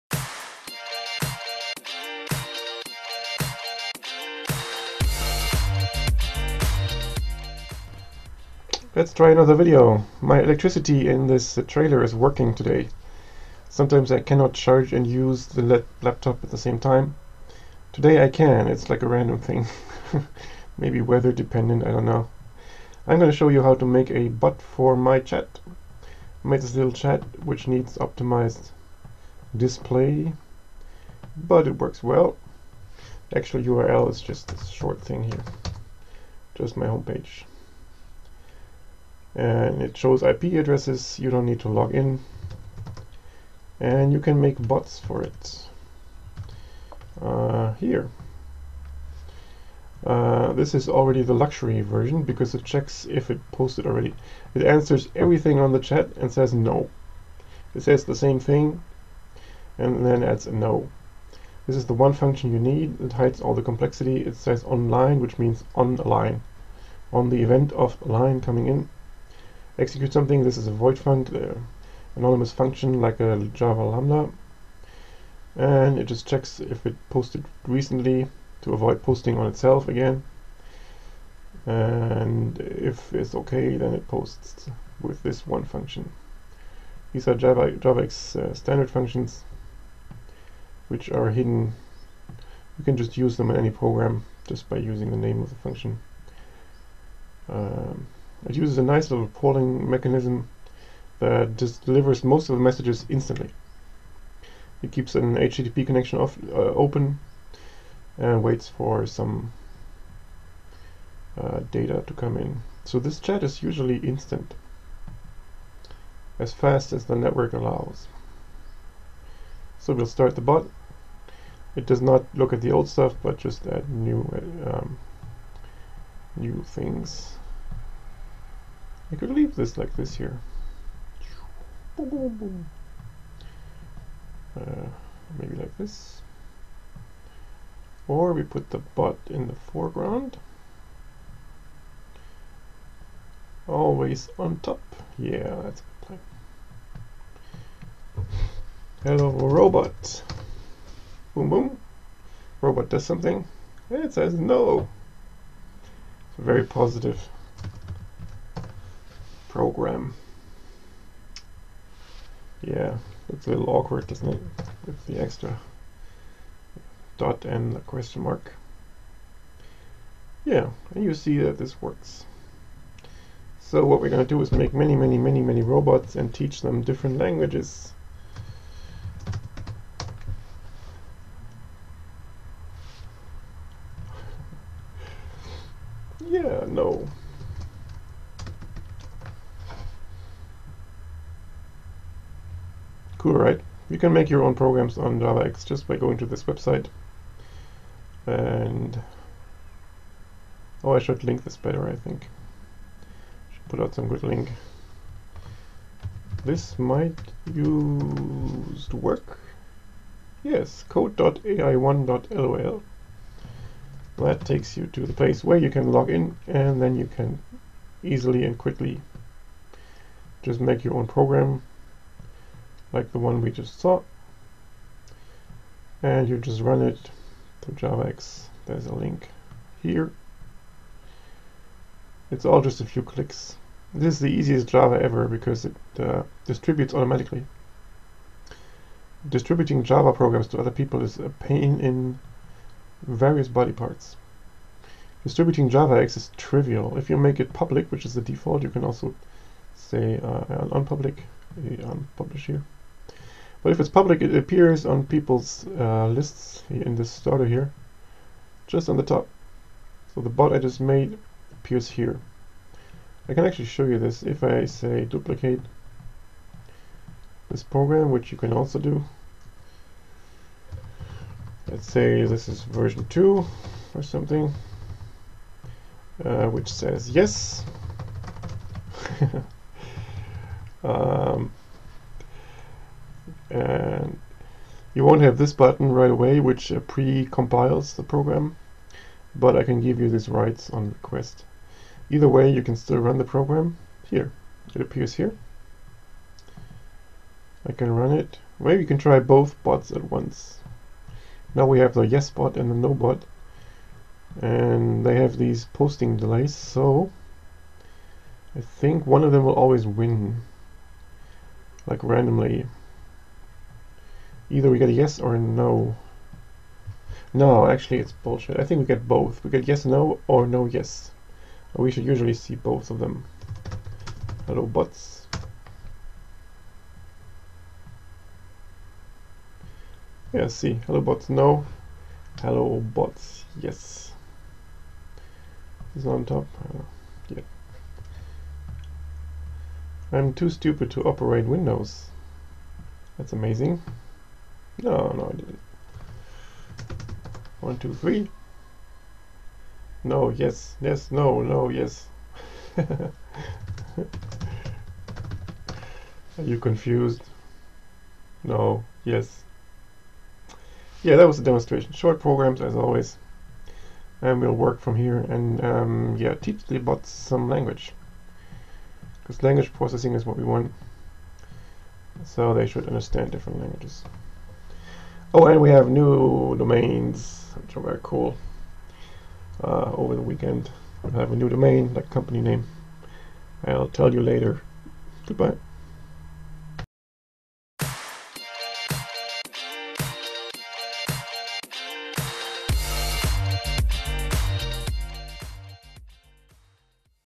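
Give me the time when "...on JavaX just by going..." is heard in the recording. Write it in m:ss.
3:14.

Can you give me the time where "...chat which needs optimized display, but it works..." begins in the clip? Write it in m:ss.
0:26.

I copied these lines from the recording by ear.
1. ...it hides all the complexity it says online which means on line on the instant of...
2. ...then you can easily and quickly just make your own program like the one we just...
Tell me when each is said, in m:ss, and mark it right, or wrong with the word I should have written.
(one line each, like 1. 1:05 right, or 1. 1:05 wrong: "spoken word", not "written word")
1. 1:02 wrong: "event", not "instant"
2. 3:36 right.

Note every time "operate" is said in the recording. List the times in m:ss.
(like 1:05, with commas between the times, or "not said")
5:41.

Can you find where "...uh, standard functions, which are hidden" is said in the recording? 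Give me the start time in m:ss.
1:28.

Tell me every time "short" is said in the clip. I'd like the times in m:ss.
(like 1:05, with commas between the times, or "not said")
0:34, 6:01.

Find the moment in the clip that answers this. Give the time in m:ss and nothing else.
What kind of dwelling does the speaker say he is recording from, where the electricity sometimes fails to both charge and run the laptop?
0:11.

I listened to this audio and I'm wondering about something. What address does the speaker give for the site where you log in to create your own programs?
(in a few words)
code.ai1.lol.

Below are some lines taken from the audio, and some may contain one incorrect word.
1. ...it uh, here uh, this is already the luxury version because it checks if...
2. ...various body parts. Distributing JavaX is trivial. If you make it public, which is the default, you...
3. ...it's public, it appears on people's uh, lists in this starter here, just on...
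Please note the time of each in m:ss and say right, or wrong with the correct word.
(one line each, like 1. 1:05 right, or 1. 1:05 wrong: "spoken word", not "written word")
1. 0:45 right
2. 4:03 right
3. 4:13 right.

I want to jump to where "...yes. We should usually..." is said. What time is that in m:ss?
5:20.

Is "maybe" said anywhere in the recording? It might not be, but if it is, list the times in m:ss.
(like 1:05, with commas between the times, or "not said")
0:20, 2:15, 4:58.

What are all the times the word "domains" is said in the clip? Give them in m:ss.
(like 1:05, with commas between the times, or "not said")
6:16, 6:21.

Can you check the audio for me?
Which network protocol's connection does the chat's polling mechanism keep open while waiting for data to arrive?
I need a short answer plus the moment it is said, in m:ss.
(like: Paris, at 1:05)
HTTP, at 1:45.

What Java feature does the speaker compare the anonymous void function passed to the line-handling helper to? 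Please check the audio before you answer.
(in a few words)
Java lambda.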